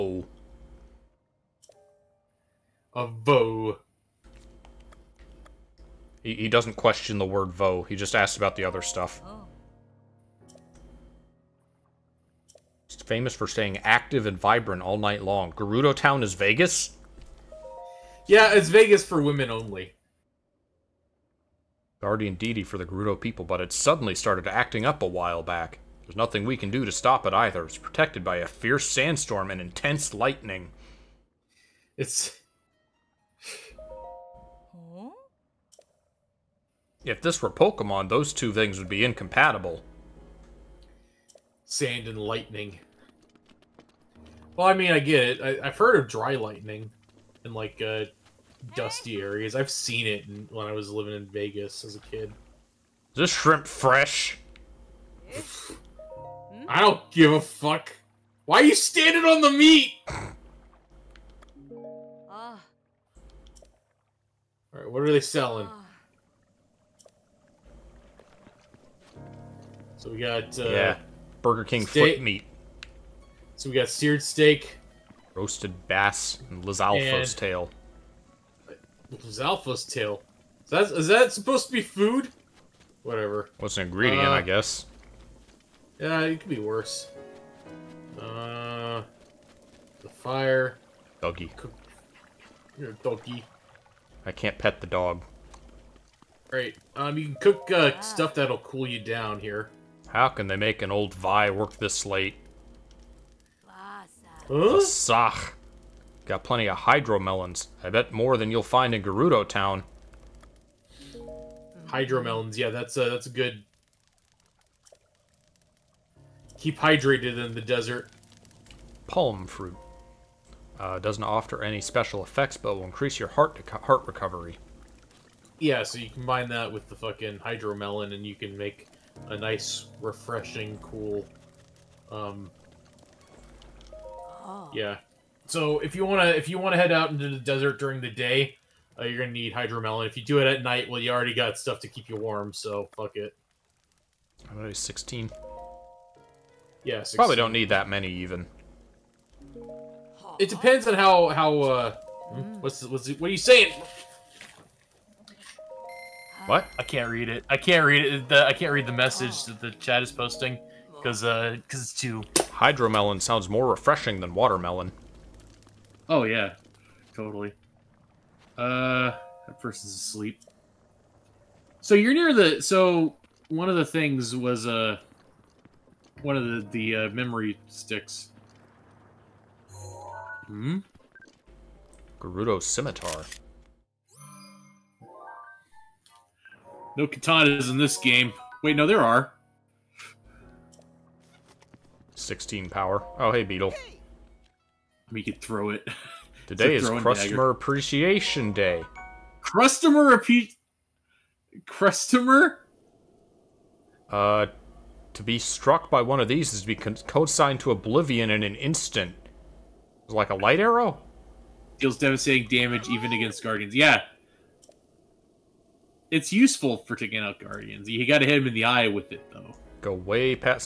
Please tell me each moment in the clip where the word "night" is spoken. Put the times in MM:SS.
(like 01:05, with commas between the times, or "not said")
00:14, 02:20.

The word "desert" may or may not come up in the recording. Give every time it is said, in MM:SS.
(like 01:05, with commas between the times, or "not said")
01:57, 02:17.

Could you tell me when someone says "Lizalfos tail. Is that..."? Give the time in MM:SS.
01:19.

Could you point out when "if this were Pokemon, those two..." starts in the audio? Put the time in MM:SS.
00:37.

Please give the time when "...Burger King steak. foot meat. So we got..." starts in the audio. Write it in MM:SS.
01:11.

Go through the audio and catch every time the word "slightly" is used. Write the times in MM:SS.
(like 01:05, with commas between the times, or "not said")
not said.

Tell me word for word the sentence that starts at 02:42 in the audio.
Hydromelon sounds more refreshing than watermelon.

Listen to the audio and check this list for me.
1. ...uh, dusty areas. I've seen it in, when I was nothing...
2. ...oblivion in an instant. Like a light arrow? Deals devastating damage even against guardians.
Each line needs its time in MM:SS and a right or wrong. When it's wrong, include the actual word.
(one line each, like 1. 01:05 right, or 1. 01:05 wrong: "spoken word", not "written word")
1. 00:47 wrong: "living", not "nothing"
2. 03:27 right.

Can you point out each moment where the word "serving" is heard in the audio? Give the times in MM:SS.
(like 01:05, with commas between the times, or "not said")
not said.